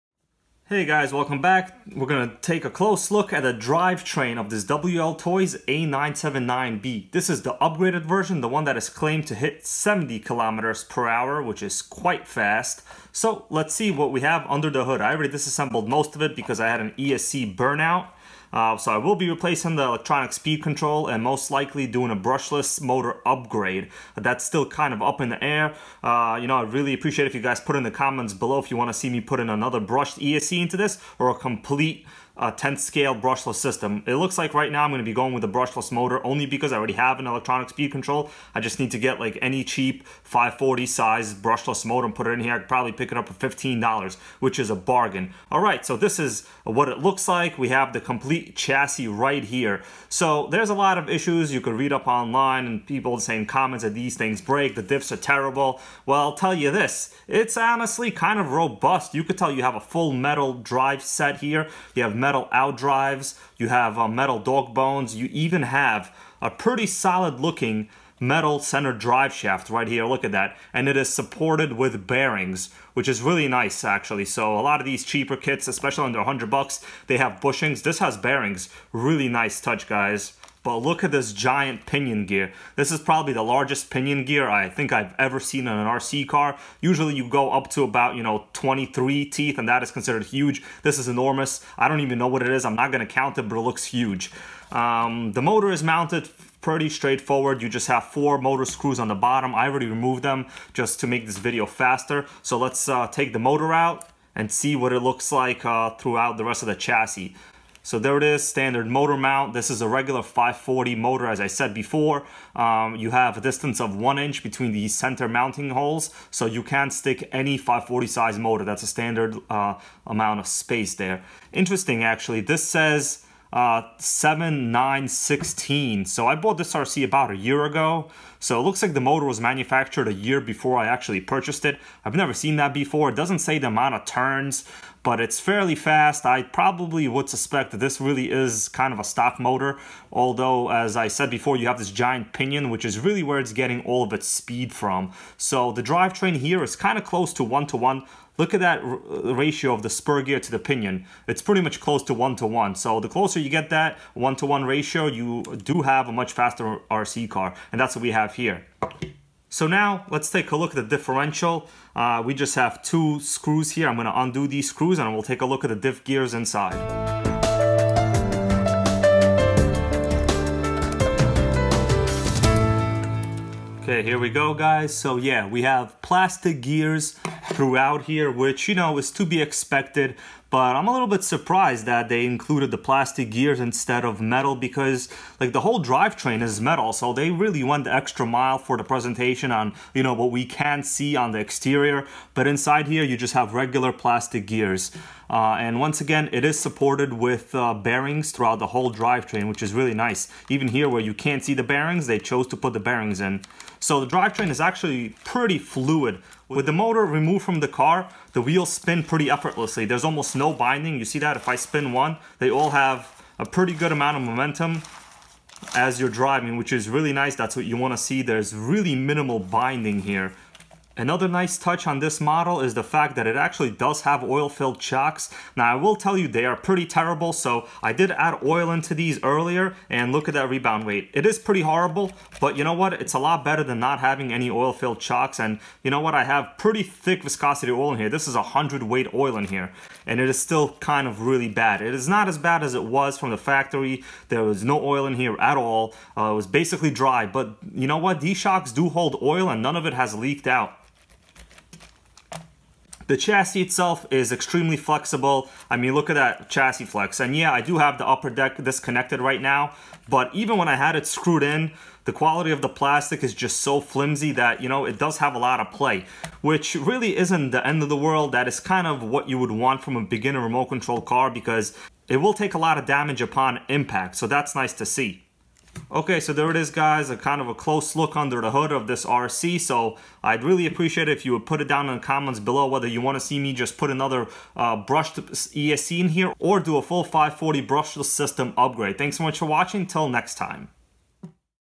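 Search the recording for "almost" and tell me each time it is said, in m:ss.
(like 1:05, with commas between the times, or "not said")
3:30.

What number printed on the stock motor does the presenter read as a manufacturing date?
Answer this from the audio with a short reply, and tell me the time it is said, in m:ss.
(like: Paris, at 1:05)
7916, at 2:03.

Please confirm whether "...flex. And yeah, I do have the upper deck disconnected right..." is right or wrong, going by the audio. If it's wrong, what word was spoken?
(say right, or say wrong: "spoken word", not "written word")
right.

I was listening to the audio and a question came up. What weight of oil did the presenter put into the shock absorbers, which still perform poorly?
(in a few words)
100 weight.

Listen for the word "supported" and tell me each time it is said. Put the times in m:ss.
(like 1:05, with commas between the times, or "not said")
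1:11, 3:16.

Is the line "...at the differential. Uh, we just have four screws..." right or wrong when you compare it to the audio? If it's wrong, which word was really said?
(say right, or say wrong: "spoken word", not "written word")
wrong: "two", not "four".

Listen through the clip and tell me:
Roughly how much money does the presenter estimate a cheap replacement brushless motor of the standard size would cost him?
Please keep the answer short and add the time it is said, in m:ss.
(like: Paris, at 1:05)
$15, at 0:43.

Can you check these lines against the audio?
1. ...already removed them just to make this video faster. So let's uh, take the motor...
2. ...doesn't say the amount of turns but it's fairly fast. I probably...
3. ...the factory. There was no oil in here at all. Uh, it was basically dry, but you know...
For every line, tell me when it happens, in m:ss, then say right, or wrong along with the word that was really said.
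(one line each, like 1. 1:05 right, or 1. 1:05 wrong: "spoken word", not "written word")
1. 1:39 right
2. 2:13 right
3. 4:03 right.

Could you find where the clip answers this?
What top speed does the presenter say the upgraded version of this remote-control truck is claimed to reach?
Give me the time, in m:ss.
0:09.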